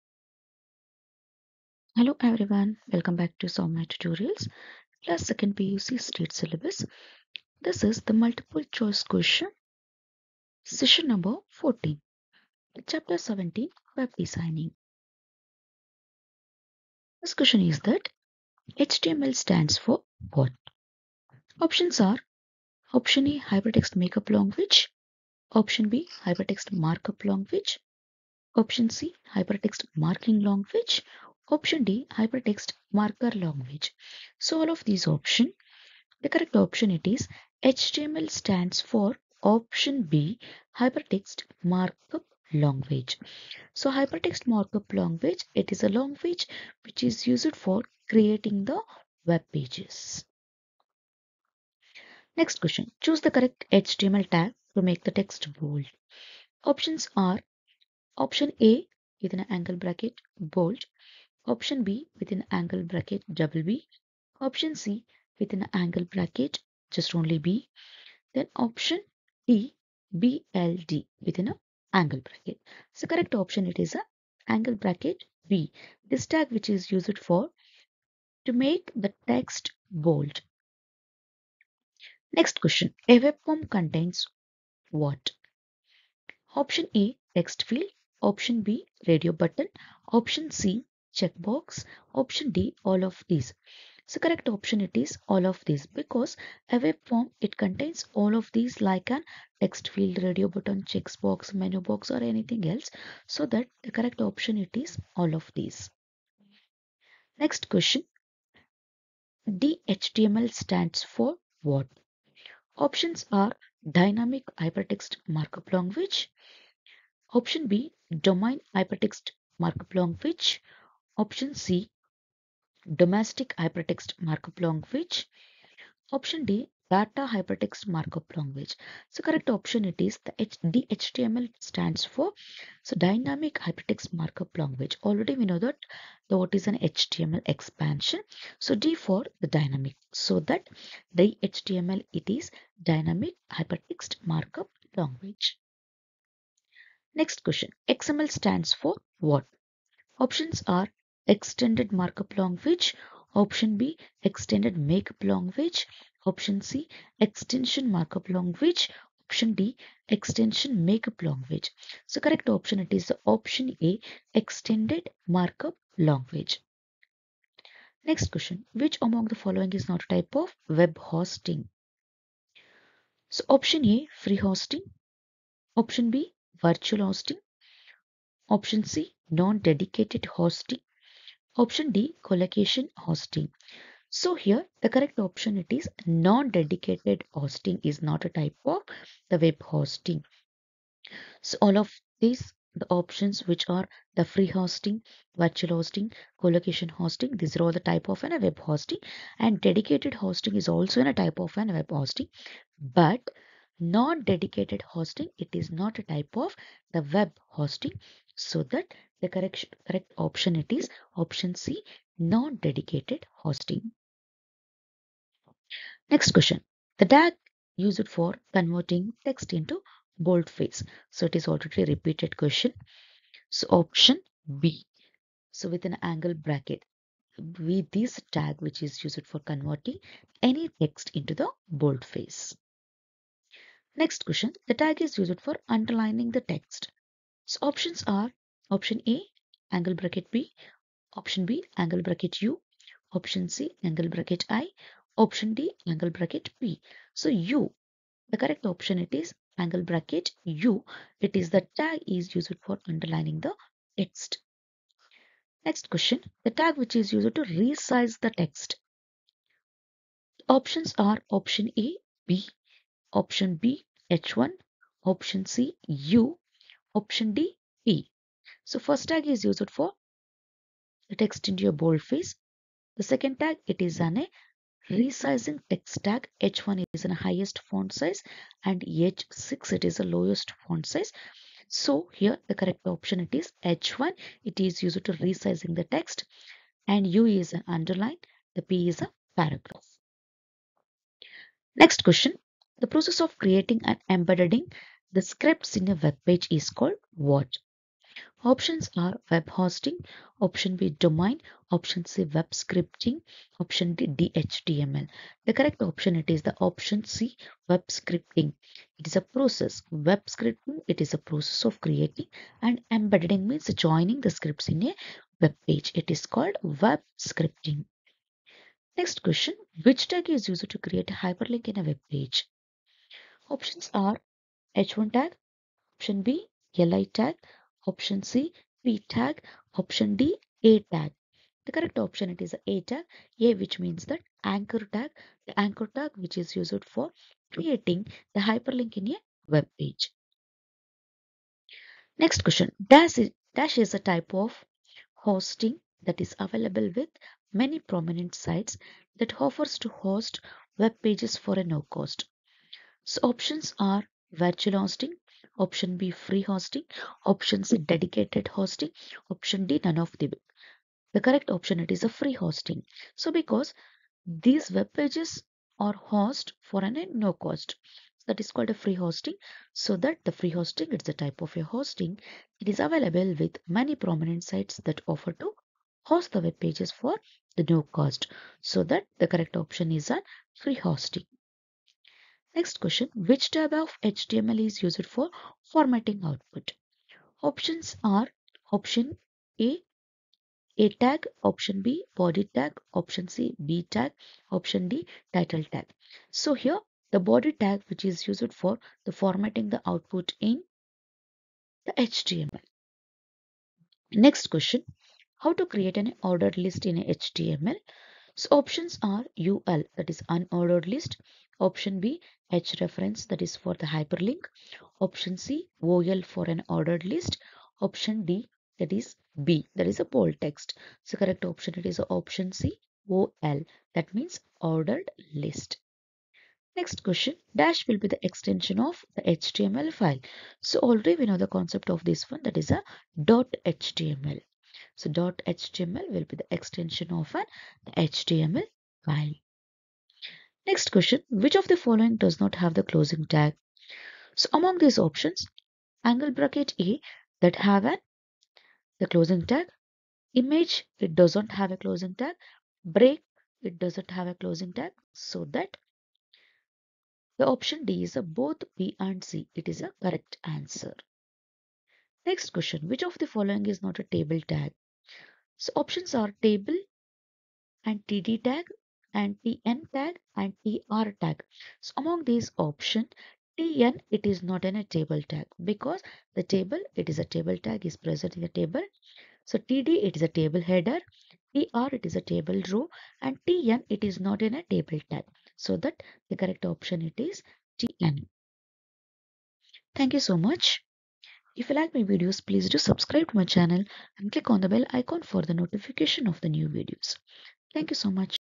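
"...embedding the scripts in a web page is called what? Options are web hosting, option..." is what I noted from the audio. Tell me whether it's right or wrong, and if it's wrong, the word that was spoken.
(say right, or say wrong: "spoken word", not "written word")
right.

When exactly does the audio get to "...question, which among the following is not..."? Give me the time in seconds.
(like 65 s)
168 s.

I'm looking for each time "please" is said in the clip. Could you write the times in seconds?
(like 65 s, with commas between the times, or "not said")
492 s.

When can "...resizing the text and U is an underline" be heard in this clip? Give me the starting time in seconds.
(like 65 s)
285 s.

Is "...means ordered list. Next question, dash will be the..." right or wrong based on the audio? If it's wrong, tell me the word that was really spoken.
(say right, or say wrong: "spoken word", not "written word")
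right.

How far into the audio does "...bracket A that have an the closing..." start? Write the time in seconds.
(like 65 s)
446 s.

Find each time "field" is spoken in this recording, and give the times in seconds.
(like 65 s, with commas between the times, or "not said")
87 s, 99 s.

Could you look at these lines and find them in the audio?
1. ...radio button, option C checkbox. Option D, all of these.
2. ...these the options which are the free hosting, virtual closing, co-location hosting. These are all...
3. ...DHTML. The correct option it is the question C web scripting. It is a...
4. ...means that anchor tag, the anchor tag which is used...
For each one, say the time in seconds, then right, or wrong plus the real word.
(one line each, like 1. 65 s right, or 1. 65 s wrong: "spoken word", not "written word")
1. 89 s right
2. 192 s wrong: "hosting", not "closing"
3. 304 s wrong: "option", not "question"
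4. 333 s right.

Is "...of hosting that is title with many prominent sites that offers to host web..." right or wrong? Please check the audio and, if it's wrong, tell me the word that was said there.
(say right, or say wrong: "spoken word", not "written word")
wrong: "available", not "title".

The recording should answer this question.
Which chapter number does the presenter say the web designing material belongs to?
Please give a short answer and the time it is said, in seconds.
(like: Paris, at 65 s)
17, at 12 s.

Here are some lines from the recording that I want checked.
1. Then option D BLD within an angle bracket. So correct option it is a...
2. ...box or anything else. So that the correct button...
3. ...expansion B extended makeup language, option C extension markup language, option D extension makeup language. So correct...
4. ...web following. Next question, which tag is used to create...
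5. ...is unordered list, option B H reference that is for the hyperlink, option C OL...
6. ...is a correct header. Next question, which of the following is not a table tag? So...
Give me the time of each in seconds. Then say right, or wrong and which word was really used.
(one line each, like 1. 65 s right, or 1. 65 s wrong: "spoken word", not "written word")
1. 68 s right
2. 101 s wrong: "option", not "button"
3. 153 s wrong: "option", not "expansion"
4. 316 s wrong: "scripting", not "following"
5. 410 s right
6. 459 s wrong: "answer", not "header".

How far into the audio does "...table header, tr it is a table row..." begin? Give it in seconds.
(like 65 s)
480 s.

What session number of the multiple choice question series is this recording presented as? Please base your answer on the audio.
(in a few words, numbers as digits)
14.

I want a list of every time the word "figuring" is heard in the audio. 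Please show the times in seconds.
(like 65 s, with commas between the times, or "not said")
not said.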